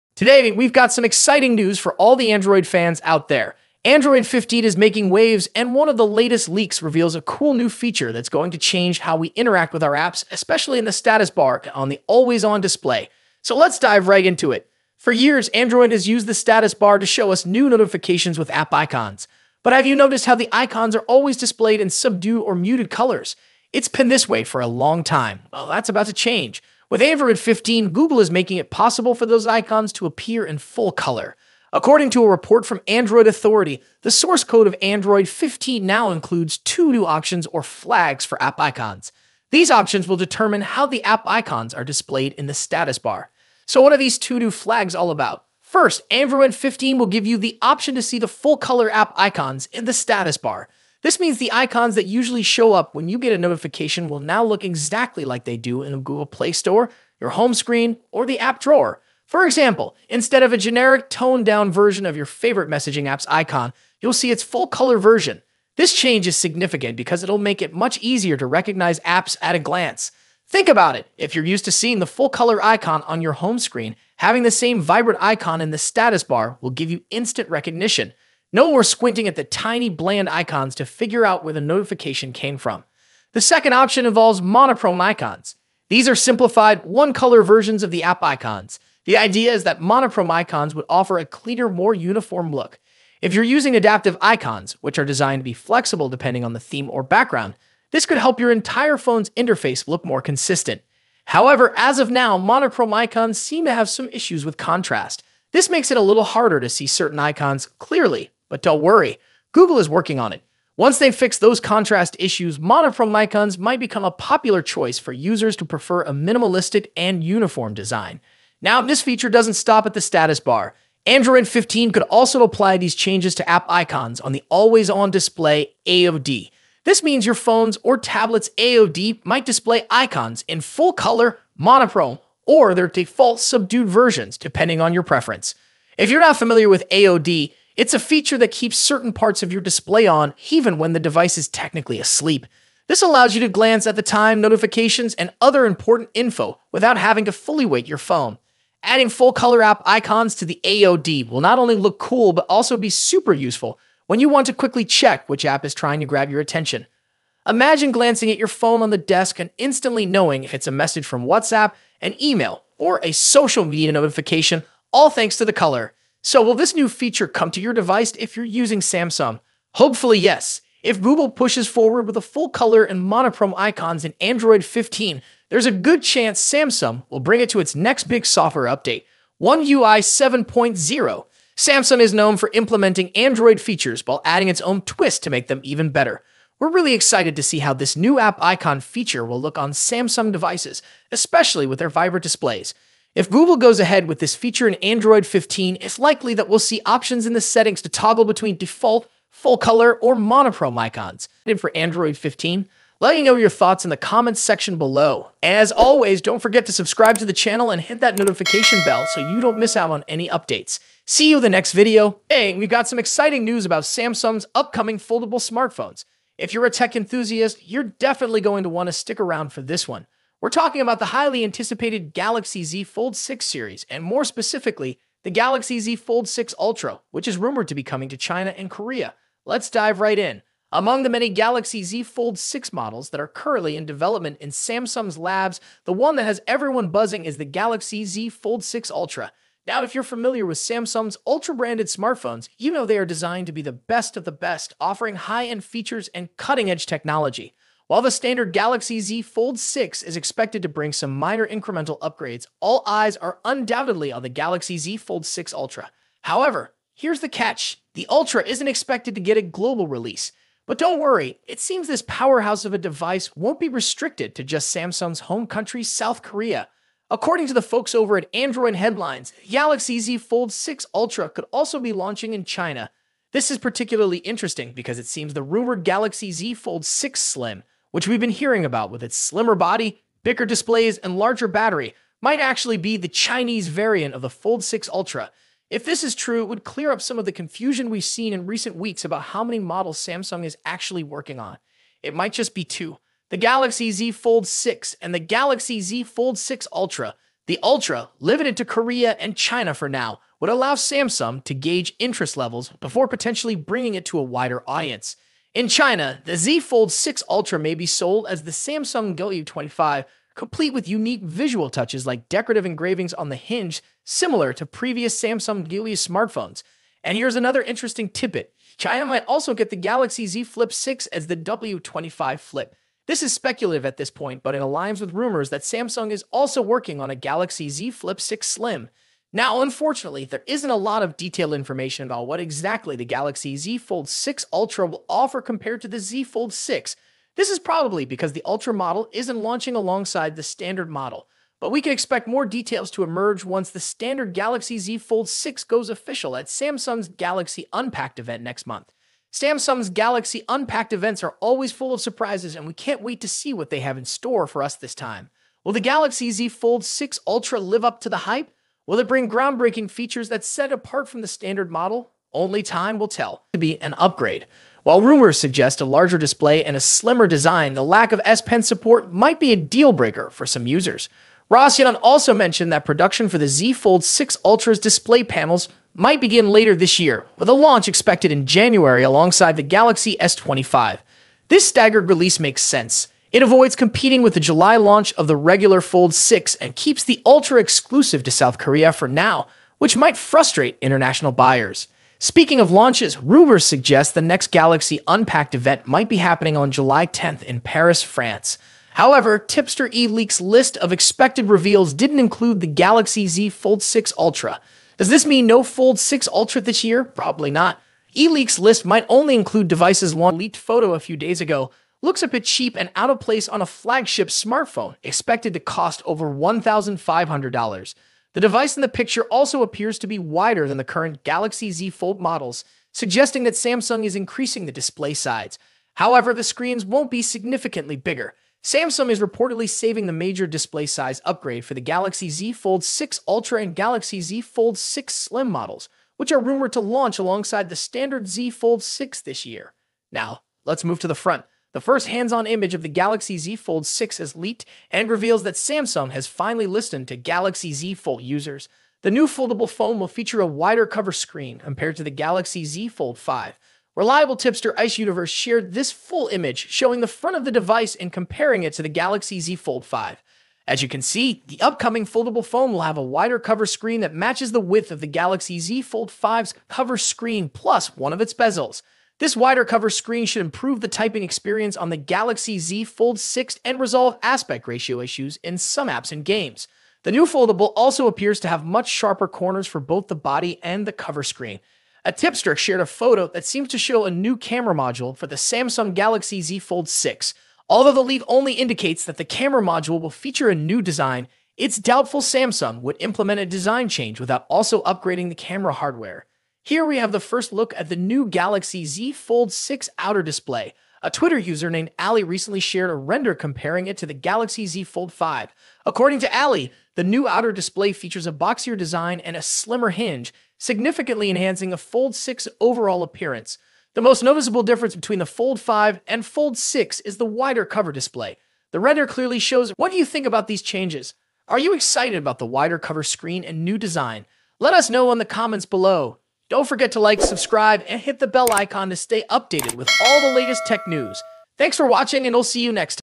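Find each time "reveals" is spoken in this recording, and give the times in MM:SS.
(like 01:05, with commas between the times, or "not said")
00:06, 06:41, 07:25.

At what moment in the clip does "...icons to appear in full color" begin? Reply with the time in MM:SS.
00:29.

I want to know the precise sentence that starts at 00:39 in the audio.
These options will determine how the app icons are displayed in the status bar.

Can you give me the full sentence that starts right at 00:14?
For years, Android has used the status bar to show us new notifications with app icons.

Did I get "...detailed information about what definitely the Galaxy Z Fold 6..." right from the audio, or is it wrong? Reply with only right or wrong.
wrong.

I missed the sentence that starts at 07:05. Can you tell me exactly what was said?
However, the screens won't be significantly bigger.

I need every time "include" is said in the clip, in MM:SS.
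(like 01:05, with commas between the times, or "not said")
00:36, 06:42, 06:49.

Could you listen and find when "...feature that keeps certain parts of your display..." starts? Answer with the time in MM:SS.
02:17.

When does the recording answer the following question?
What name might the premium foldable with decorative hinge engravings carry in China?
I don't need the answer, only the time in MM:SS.
05:08.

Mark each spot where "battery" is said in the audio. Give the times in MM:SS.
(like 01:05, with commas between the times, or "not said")
04:41.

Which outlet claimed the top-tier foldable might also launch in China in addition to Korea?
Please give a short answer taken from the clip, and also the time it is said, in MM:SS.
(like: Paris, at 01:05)
Android Headlines, at 04:28.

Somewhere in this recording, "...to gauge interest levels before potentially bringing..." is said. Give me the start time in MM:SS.
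05:01.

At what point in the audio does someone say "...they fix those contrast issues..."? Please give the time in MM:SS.
01:50.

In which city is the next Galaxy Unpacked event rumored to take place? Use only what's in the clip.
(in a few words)
Paris.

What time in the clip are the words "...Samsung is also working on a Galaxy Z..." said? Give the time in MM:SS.
05:25.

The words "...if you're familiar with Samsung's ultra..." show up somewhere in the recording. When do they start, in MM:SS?
03:59.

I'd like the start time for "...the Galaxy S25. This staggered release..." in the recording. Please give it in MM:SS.
06:19.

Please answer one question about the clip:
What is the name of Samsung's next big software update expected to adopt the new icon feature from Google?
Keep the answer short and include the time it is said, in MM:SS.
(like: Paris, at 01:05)
One UI 7.0, at 02:59.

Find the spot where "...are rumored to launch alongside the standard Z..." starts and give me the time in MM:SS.
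07:16.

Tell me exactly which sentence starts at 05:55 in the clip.
Will the Galaxy Z Fold 6 Ultra live up to the hype?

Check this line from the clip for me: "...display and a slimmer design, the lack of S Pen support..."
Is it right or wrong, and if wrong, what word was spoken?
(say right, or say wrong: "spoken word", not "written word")
right.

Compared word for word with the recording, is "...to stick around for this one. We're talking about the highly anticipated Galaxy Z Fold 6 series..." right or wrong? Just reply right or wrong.
right.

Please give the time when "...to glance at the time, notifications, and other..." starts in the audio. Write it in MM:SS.
02:23.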